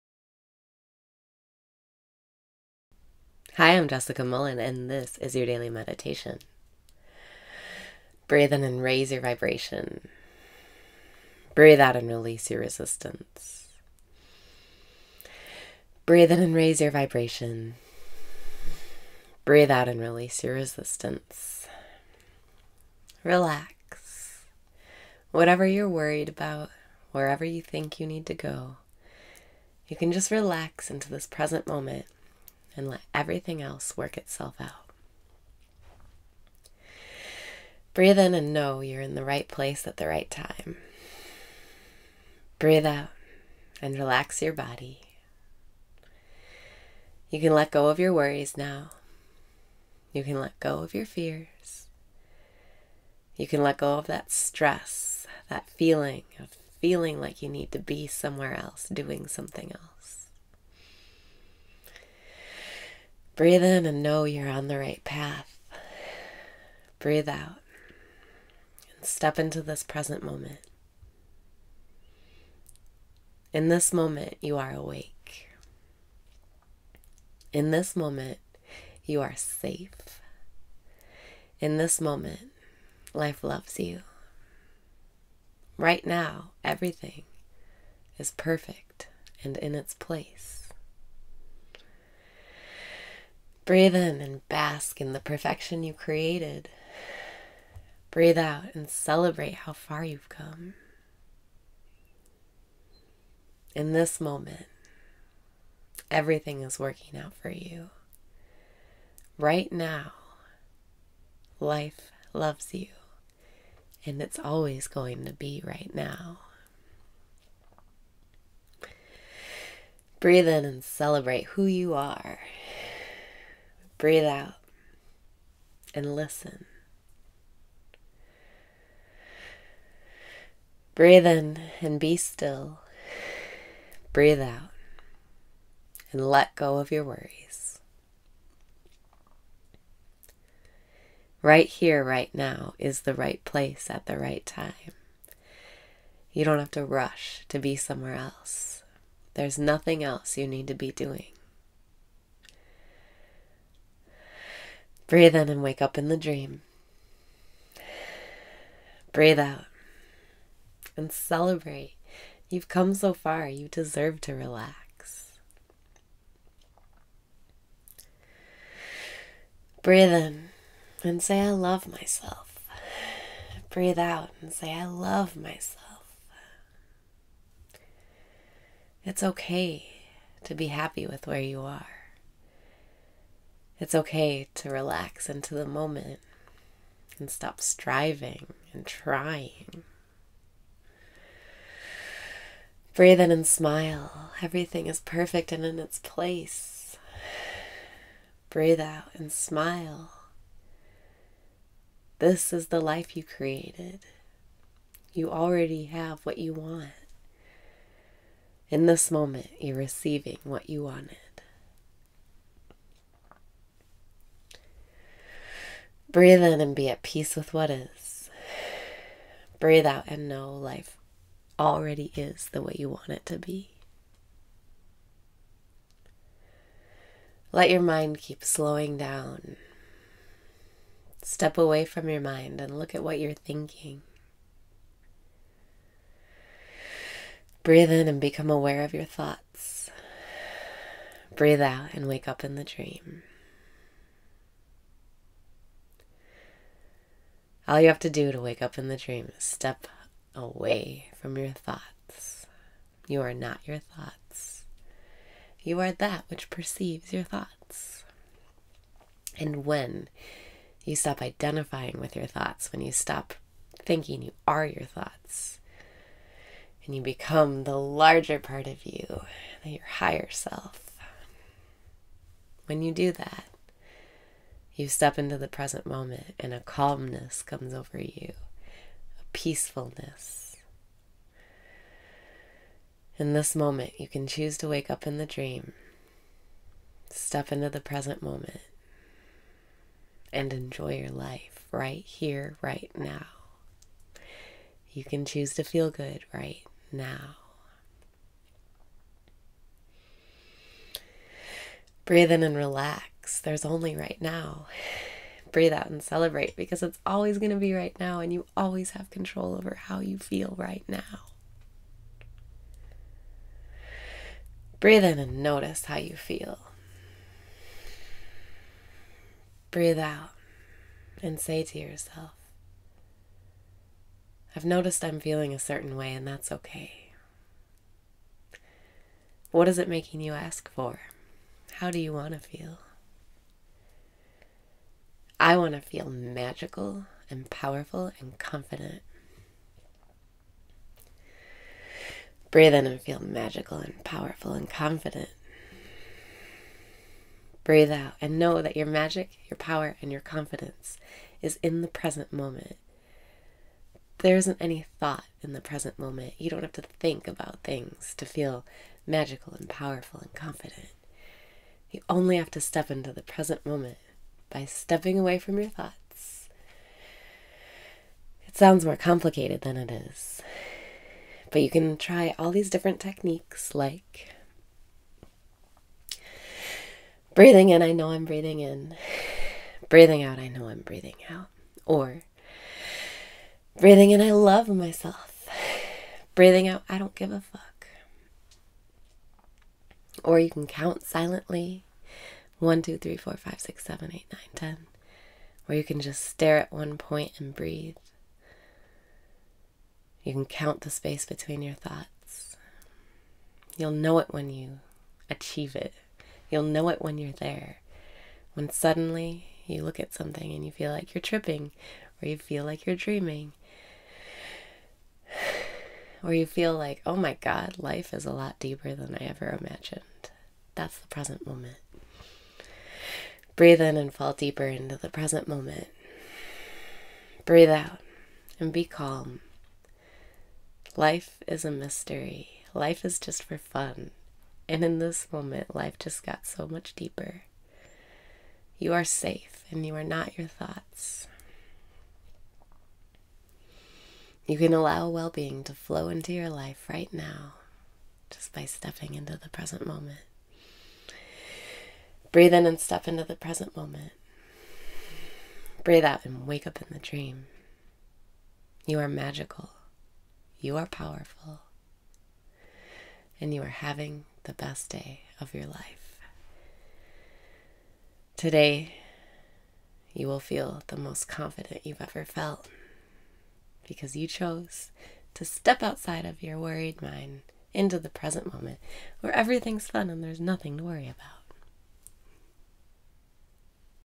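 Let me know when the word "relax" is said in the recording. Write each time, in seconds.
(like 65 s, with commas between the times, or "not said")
23 s, 30 s, 43 s, 164 s, 184 s, 302 s.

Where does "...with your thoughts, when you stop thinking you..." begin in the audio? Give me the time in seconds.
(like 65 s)
262 s.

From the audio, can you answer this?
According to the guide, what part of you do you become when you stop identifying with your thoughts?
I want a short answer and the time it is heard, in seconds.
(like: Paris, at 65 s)
higher self, at 269 s.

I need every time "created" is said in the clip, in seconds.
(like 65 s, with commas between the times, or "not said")
95 s, 203 s.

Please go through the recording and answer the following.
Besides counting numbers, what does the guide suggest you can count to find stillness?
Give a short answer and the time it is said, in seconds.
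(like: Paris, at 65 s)
the space between your thoughts, at 400 s.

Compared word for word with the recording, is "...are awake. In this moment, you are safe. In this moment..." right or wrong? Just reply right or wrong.
right.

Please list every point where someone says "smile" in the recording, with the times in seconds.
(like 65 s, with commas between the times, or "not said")
193 s, 199 s.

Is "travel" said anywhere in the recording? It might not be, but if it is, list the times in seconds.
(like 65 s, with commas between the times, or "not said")
not said.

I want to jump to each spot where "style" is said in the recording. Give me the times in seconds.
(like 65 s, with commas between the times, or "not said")
not said.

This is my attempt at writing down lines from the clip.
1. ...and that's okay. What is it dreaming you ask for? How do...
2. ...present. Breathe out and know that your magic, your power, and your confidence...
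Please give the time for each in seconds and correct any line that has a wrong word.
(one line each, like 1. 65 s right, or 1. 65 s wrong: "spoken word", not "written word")
1. 326 s wrong: "making", not "dreaming"
2. 344 s wrong: "confident", not "present".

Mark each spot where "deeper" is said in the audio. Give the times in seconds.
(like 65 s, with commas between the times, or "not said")
418 s, 424 s, 436 s.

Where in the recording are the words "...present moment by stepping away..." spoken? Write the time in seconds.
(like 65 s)
363 s.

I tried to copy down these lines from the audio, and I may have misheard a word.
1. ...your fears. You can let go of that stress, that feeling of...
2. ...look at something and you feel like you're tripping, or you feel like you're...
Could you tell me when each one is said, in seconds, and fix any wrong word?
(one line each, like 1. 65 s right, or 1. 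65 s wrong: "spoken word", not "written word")
1. 50 s right
2. 409 s right.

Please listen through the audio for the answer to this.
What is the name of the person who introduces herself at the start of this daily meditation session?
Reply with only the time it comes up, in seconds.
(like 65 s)
3 s.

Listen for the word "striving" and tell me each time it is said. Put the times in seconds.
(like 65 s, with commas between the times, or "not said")
187 s.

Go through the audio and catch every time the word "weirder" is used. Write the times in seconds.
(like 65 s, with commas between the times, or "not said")
not said.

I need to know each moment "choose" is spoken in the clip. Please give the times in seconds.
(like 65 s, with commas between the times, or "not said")
284 s, 295 s.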